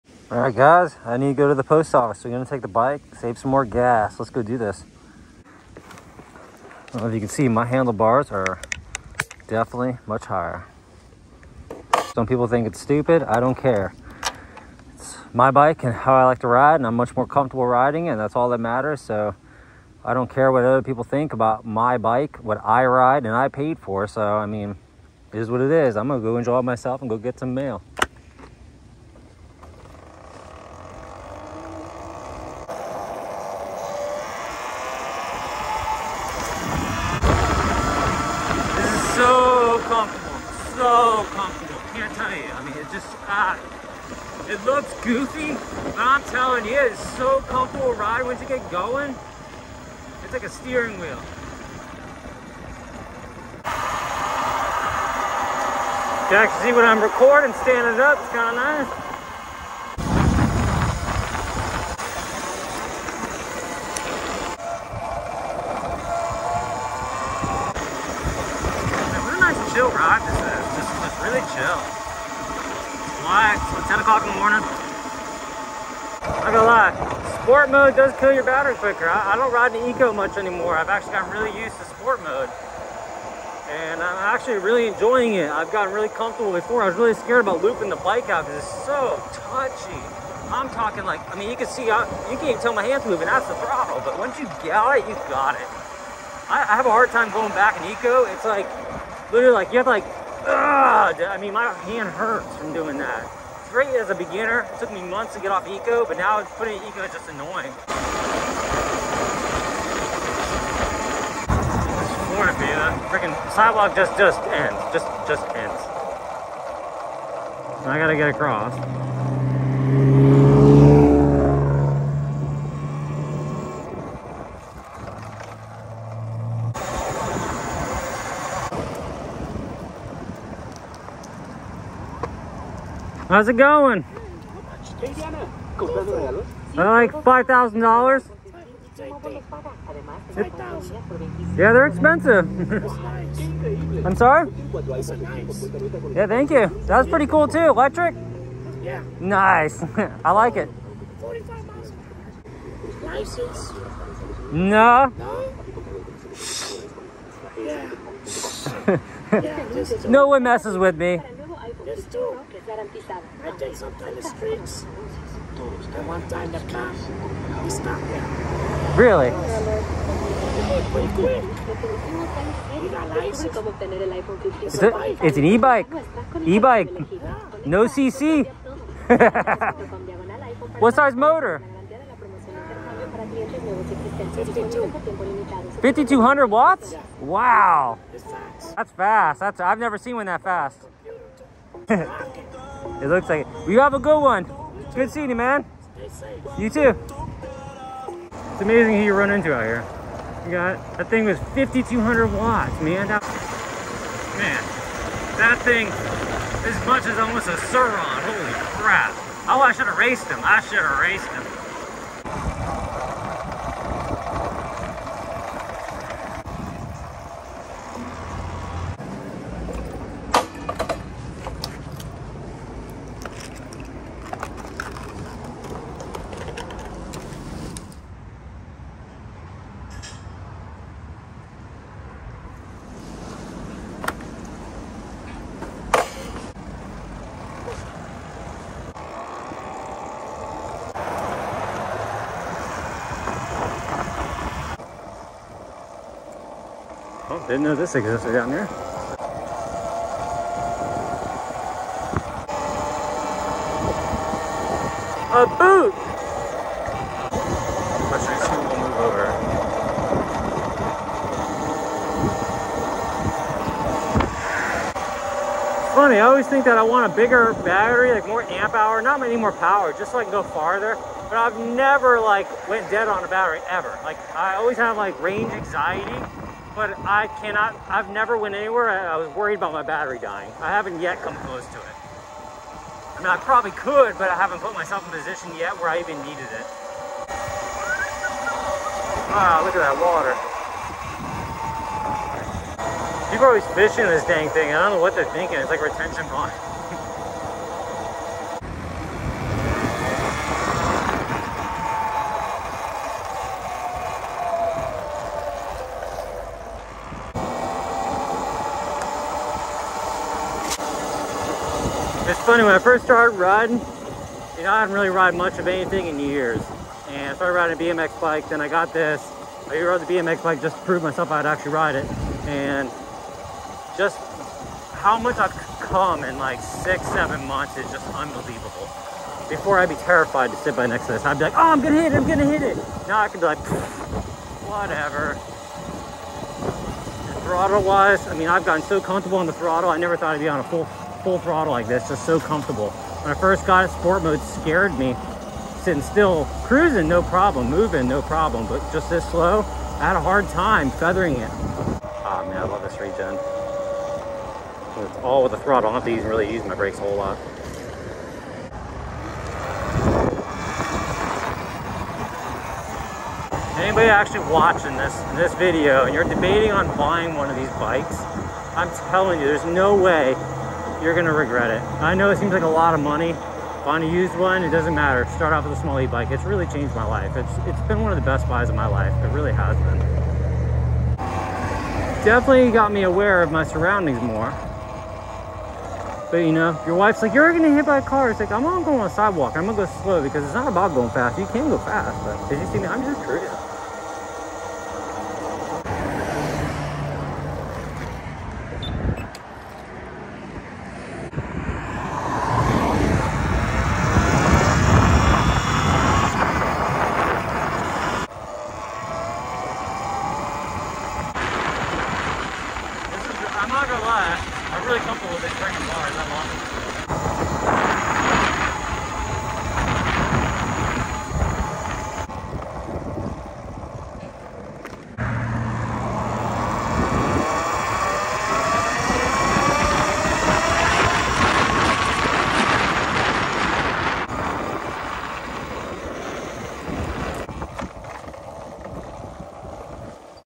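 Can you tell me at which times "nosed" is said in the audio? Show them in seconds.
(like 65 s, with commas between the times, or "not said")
not said.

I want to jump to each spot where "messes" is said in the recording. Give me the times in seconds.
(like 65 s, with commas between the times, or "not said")
160 s.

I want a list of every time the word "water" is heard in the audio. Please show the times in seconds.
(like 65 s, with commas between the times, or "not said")
289 s.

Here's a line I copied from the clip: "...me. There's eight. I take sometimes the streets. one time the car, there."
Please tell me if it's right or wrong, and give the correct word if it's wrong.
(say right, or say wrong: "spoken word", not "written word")
wrong: "two", not "eight".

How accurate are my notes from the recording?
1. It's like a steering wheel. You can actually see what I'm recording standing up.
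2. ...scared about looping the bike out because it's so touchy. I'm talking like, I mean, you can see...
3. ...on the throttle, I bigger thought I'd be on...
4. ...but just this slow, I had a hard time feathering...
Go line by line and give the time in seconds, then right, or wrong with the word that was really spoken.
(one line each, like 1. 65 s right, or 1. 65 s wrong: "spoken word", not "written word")
1. 50 s right
2. 87 s right
3. 339 s wrong: "never", not "bigger"
4. 348 s right.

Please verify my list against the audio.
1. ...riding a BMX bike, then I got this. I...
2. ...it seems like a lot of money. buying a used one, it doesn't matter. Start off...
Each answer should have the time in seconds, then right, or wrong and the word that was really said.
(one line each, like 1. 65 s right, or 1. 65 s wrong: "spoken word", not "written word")
1. 317 s right
2. 372 s right.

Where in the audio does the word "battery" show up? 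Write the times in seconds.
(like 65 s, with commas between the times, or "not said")
78 s, 267 s, 273 s, 279 s.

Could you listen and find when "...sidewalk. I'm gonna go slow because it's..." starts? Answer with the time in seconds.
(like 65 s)
389 s.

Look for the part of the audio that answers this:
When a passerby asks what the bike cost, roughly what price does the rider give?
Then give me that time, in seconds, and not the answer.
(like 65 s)
137 s.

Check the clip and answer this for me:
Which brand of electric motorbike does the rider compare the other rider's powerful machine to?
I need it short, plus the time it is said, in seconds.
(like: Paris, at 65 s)
Surron, at 207 s.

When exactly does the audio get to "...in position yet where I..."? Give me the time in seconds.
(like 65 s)
285 s.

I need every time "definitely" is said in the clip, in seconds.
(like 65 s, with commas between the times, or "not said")
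9 s, 382 s.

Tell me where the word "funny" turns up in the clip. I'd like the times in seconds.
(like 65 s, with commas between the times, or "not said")
265 s, 312 s.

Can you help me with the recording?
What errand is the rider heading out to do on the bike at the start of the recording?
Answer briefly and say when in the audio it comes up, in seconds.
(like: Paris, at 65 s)
Go to the post office, at 1 s.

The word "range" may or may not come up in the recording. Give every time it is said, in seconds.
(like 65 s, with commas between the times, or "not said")
275 s.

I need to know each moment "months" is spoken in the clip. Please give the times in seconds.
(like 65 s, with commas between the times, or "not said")
105 s, 327 s.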